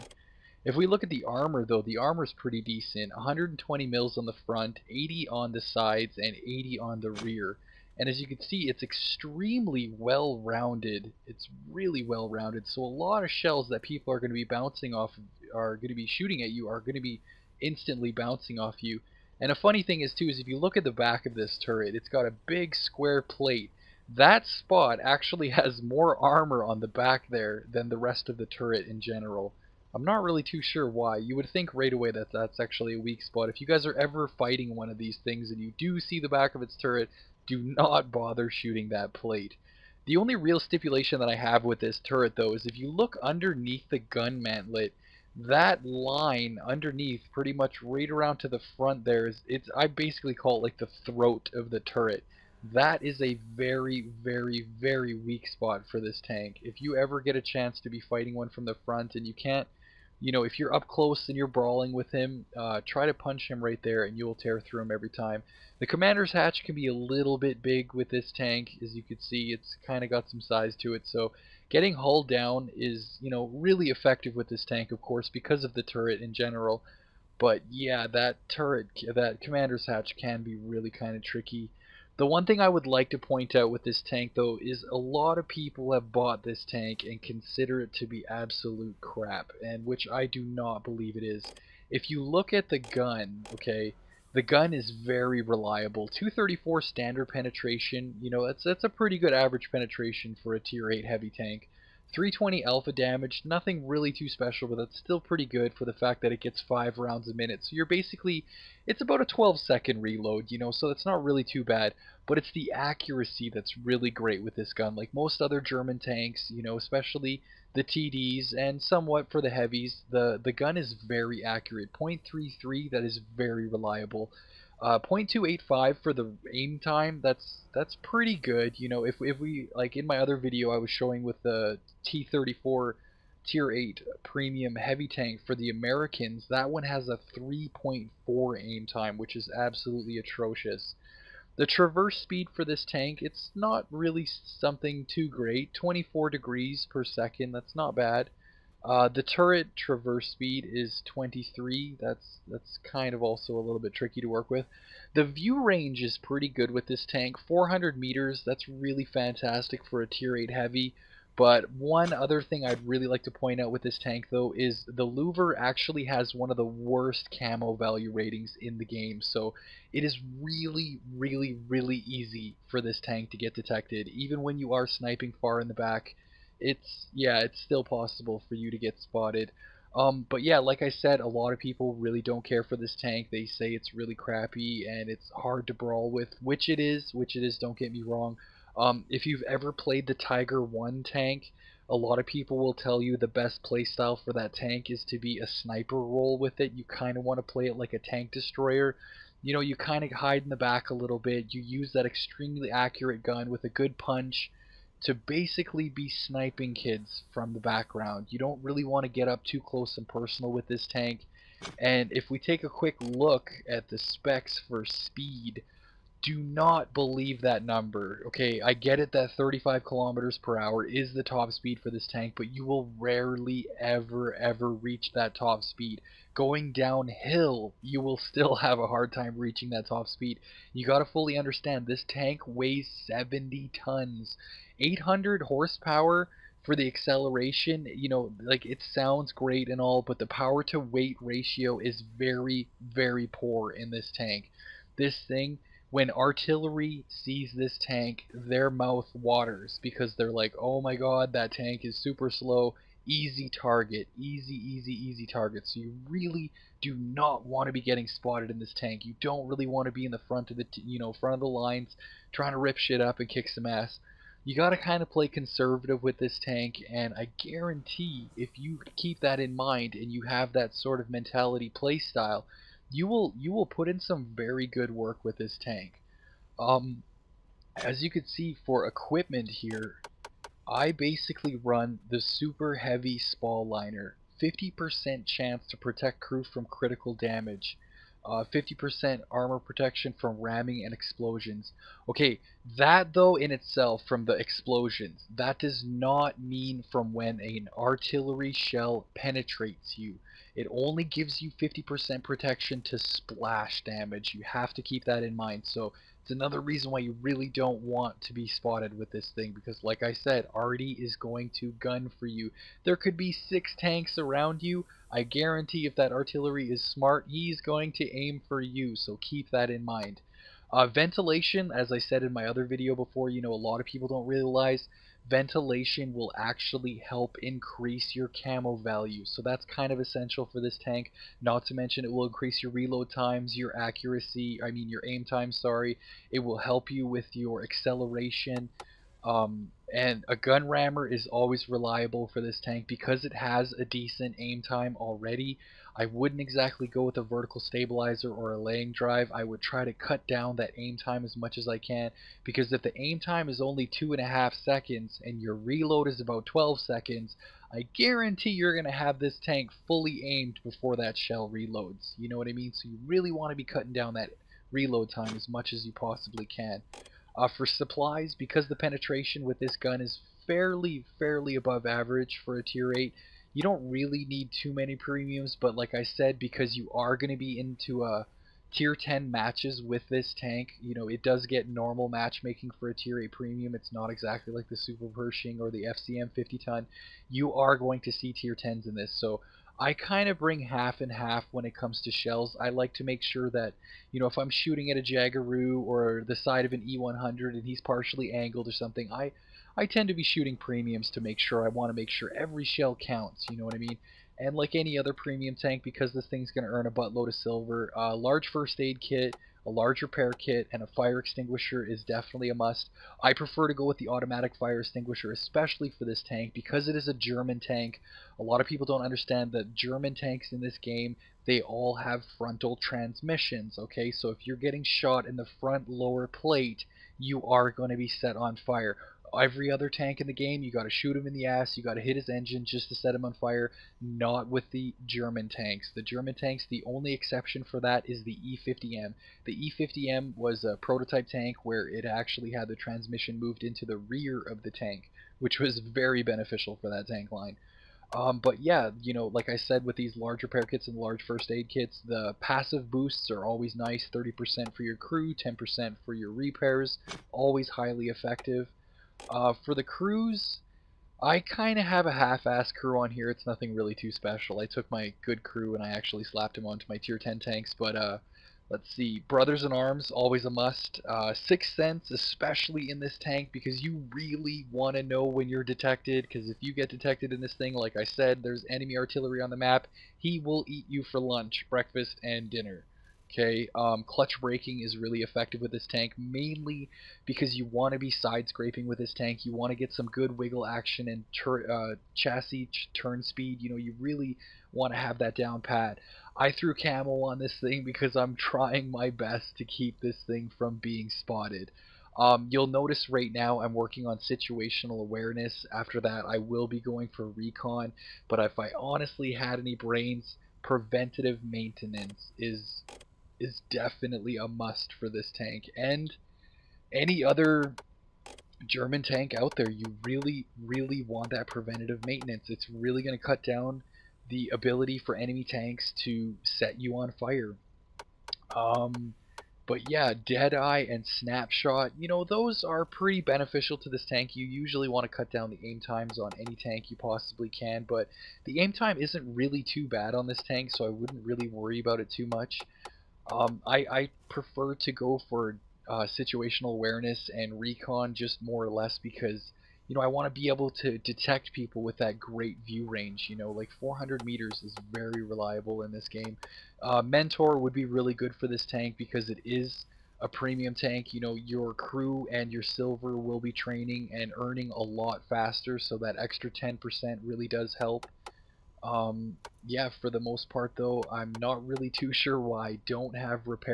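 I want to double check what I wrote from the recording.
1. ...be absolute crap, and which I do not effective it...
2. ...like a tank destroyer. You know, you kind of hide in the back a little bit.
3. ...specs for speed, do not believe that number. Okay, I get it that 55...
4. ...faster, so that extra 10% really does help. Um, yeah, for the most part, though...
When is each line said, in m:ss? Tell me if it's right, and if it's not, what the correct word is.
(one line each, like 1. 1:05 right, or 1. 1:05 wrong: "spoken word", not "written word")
1. 1:28 wrong: "believe", not "effective"
2. 3:17 right
3. 3:33 wrong: "35", not "55"
4. 9:25 right.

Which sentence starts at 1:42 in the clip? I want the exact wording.
320 alpha damage, nothing really too special, but that's still pretty good for the fact that it gets 5 rounds a minute.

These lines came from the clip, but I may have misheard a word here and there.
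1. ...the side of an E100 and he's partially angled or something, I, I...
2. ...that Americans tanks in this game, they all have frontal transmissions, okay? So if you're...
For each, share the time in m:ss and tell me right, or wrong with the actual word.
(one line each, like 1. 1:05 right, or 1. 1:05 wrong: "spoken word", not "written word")
1. 6:36 right
2. 6:59 wrong: "German", not "Americans".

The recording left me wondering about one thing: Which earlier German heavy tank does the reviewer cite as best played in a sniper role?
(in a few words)
Tiger 1.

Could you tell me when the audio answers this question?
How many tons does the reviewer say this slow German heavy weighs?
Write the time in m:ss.
3:53.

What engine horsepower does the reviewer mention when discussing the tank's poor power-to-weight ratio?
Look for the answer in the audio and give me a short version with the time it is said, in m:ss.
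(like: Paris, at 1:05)
800, at 3:54.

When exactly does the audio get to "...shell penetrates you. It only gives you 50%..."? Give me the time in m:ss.
4:58.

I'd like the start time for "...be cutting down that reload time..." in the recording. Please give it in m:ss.
6:03.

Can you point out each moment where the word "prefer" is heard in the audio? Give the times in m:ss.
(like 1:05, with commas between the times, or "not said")
6:53, 9:04.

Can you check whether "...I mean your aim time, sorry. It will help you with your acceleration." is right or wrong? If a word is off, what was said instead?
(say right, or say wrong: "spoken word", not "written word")
right.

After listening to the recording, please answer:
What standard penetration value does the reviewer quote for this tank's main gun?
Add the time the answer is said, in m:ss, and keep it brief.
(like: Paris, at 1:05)
234, at 1:36.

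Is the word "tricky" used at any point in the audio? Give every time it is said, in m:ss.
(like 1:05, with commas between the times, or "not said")
1:21, 2:33.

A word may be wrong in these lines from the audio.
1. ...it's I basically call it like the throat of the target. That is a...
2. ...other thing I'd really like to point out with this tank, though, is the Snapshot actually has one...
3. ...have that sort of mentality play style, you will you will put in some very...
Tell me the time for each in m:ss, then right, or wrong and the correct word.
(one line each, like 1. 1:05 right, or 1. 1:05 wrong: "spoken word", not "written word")
1. 0:49 wrong: "turret", not "target"
2. 2:42 wrong: "Louvre", not "Snapshot"
3. 4:30 right.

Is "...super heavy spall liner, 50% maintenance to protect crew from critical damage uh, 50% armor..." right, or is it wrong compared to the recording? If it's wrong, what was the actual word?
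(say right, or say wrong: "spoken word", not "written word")
wrong: "chance", not "maintenance".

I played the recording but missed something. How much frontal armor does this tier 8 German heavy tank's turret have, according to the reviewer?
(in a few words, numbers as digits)
120 mm.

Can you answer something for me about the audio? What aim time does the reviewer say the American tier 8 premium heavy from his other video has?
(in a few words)
3.4.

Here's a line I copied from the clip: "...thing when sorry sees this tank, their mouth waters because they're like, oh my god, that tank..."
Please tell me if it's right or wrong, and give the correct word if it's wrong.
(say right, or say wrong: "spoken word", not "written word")
wrong: "artillery", not "sorry".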